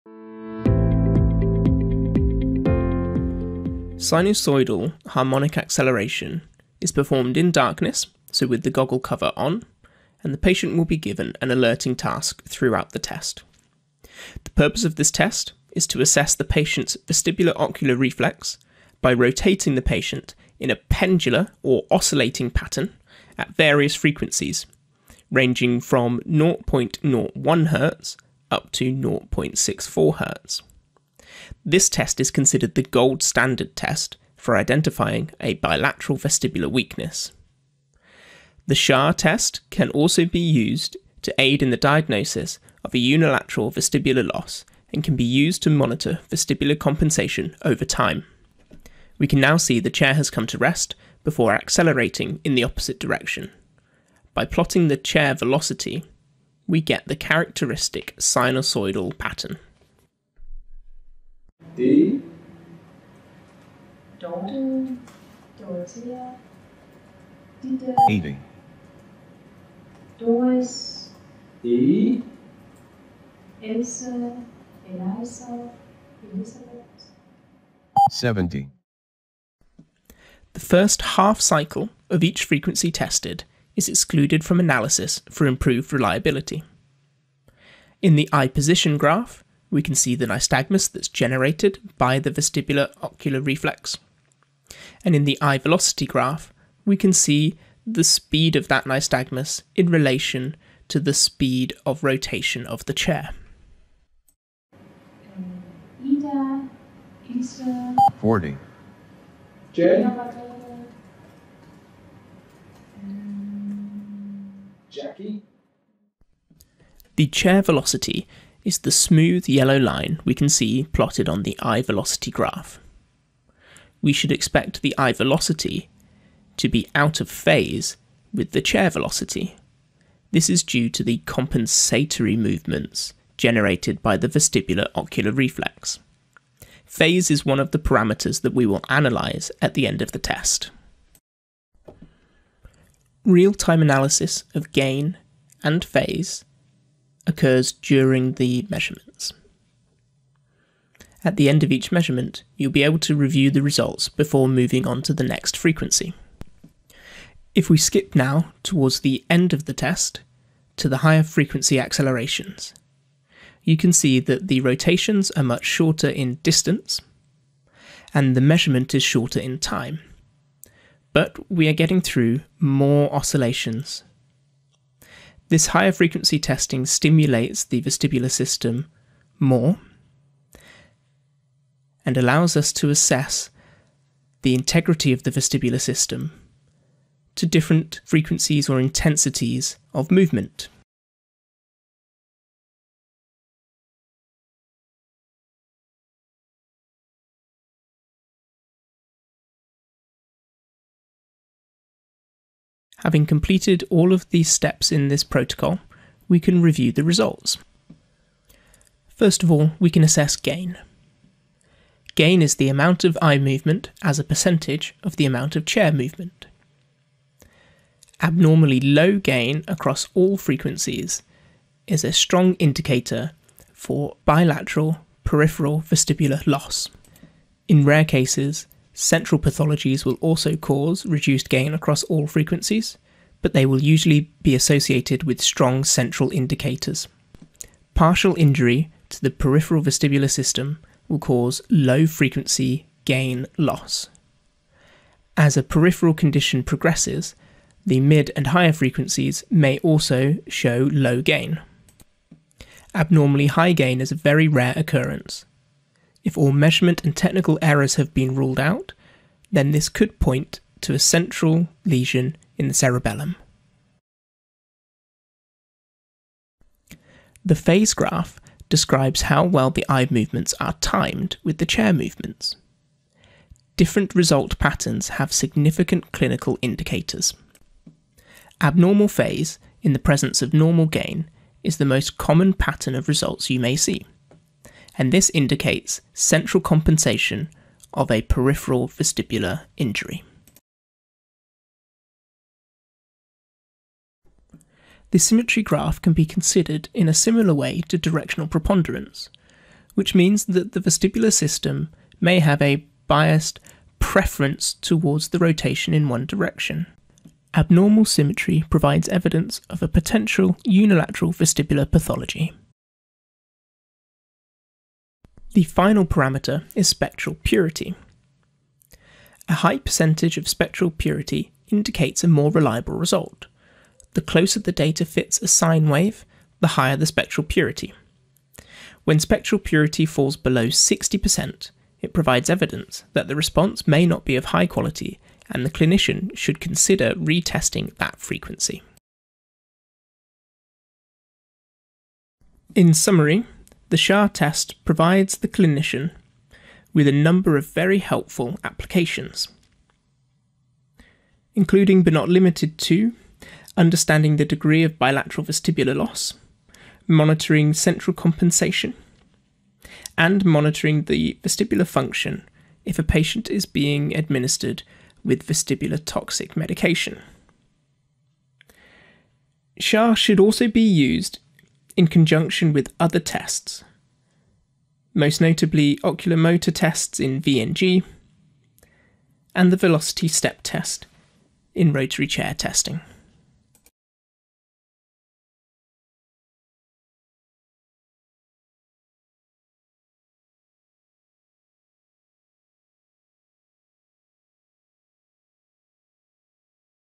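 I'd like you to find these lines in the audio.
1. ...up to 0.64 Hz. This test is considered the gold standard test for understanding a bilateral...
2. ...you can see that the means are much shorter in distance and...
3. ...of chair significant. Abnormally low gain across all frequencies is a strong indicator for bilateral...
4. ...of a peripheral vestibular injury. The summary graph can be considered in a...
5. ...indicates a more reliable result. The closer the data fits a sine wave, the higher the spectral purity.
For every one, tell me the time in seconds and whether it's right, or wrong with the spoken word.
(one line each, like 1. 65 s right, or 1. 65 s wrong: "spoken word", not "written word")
1. 28 s wrong: "identifying", not "understanding"
2. 163 s wrong: "rotations", not "means"
3. 215 s wrong: "movement", not "significant"
4. 287 s wrong: "symmetry", not "summary"
5. 321 s right.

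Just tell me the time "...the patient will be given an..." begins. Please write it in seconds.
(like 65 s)
10 s.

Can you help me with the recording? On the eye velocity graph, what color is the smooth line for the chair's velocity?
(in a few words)
Yellow.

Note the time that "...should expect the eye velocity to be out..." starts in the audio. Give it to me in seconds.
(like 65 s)
124 s.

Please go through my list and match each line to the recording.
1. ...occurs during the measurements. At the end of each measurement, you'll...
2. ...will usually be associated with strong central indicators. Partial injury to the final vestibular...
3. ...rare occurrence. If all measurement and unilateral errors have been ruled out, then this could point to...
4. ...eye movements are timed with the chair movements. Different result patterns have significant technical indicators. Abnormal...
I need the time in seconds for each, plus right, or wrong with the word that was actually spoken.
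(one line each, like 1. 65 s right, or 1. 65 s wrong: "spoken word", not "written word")
1. 147 s right
2. 233 s wrong: "peripheral", not "final"
3. 254 s wrong: "technical", not "unilateral"
4. 269 s wrong: "clinical", not "technical".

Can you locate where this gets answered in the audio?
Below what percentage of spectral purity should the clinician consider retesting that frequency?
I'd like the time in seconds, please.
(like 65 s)
330 s.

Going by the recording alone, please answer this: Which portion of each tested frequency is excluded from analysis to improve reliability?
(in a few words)
First half cycle.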